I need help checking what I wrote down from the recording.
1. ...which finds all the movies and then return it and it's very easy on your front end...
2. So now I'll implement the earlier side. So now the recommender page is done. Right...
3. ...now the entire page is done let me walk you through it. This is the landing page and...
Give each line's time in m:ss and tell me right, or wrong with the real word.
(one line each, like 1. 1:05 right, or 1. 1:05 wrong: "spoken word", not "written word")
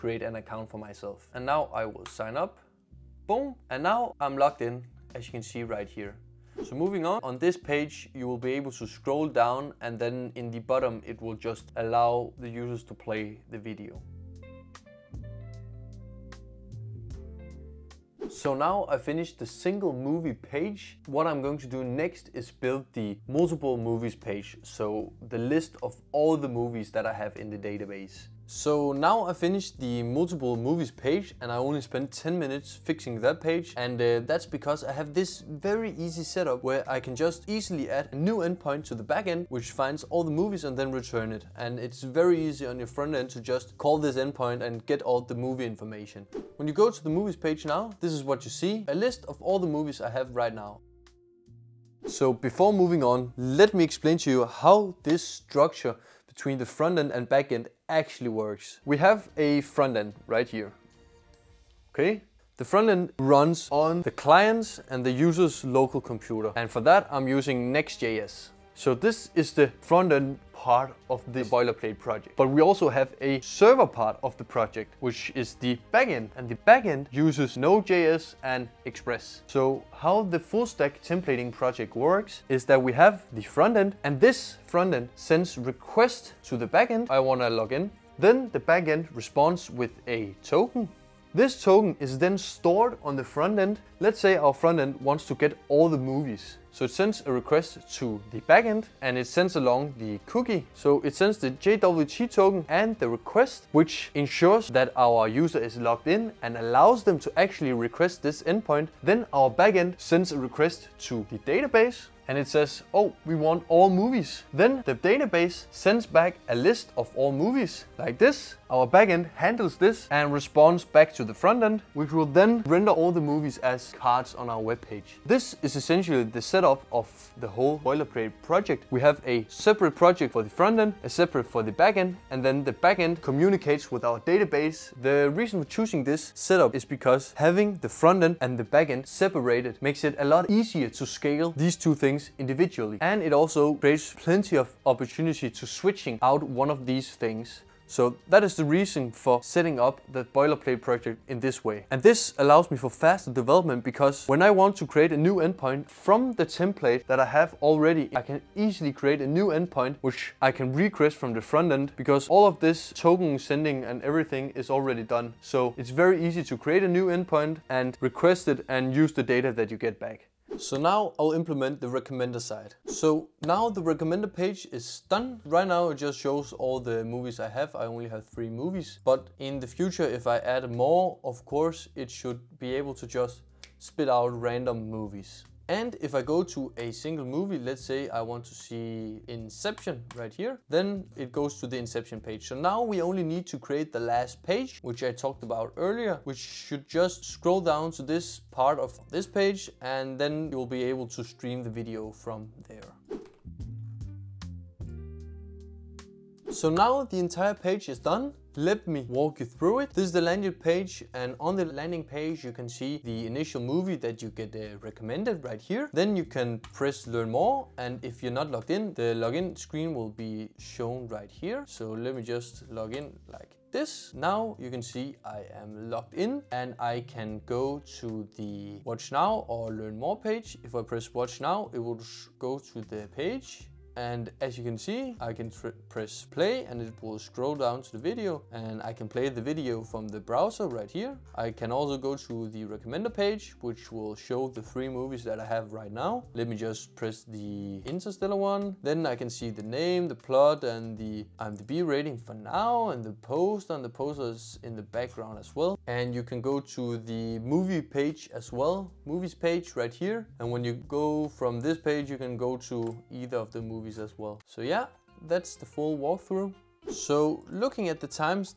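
1. 0:39 right
2. 2:50 wrong: "recommender", not "earlier"
3. 3:26 right.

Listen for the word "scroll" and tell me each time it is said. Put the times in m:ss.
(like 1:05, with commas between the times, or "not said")
0:08, 3:17, 3:57.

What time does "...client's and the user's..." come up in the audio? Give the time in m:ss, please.
1:04.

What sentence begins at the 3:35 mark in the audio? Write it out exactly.
Then you can press learn more and if you're not logged in, the login screen will be shown right here.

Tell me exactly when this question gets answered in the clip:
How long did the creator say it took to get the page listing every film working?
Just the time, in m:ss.
0:32.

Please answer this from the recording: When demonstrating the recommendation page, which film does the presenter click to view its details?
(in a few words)
Interstellar.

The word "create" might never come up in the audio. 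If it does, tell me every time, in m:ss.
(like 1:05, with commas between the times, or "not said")
2:23, 2:34, 2:38, 2:46, 3:13.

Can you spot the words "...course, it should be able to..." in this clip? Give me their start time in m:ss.
3:01.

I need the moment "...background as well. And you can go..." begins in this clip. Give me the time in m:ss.
4:14.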